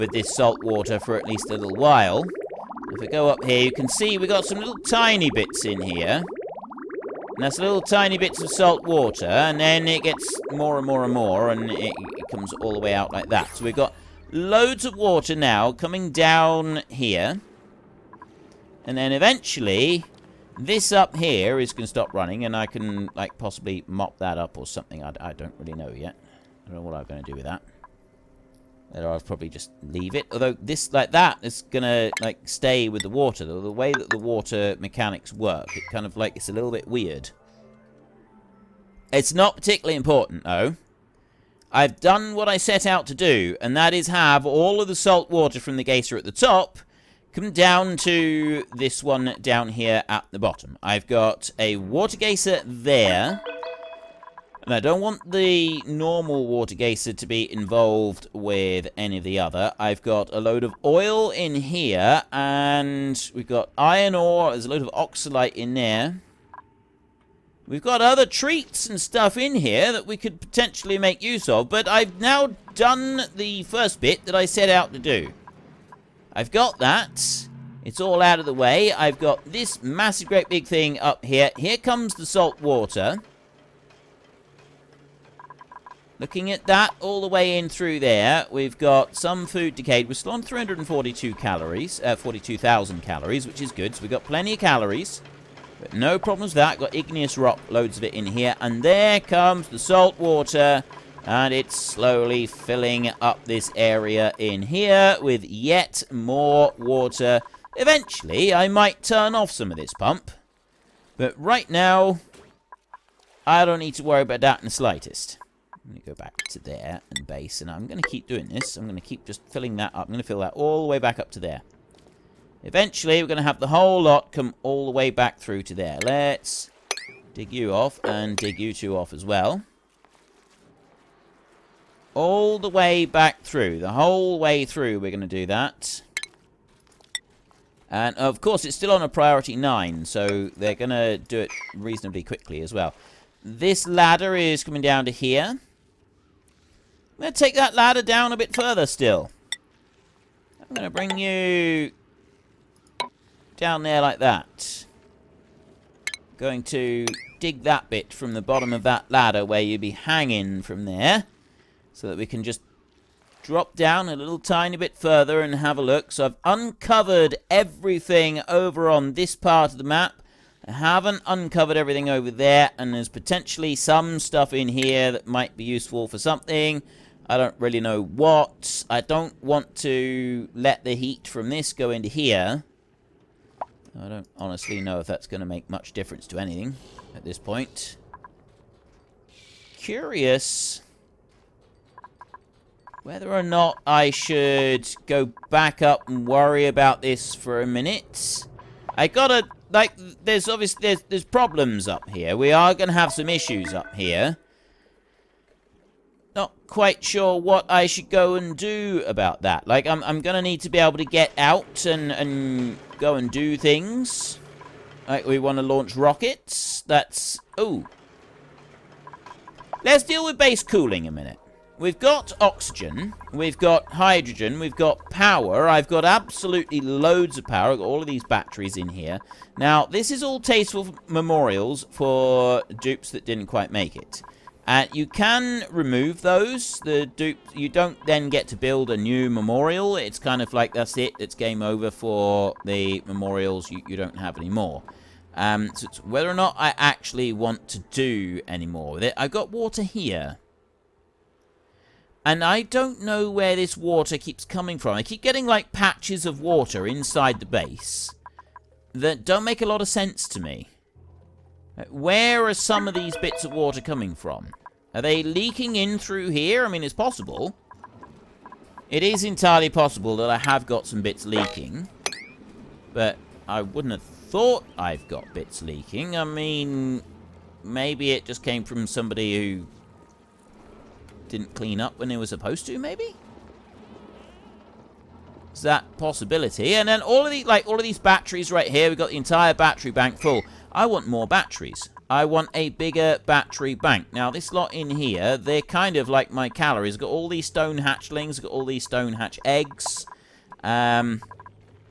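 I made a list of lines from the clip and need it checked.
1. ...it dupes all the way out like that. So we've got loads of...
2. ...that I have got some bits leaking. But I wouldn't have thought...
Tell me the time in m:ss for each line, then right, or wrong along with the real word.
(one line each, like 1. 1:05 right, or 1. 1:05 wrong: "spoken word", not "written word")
1. 0:11 wrong: "comes", not "dupes"
2. 4:30 right.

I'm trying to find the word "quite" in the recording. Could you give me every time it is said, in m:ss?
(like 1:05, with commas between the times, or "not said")
3:26, 3:53.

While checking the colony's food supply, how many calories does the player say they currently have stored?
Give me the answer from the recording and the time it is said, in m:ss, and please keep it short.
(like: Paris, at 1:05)
42,000, at 1:32.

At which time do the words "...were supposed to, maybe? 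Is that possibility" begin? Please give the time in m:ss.
4:42.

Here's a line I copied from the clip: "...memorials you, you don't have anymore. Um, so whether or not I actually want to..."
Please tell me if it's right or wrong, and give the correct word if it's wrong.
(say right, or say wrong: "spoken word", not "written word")
right.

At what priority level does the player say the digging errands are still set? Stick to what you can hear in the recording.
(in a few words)
9.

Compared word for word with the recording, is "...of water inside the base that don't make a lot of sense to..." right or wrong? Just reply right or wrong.
right.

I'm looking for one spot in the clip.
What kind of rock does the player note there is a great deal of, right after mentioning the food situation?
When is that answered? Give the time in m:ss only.
1:36.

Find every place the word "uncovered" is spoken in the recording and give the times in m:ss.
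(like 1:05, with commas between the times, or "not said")
2:46, 2:51.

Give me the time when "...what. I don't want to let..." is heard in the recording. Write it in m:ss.
2:58.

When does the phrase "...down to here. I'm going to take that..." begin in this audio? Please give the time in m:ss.
2:24.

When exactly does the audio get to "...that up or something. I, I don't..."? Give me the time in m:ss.
0:24.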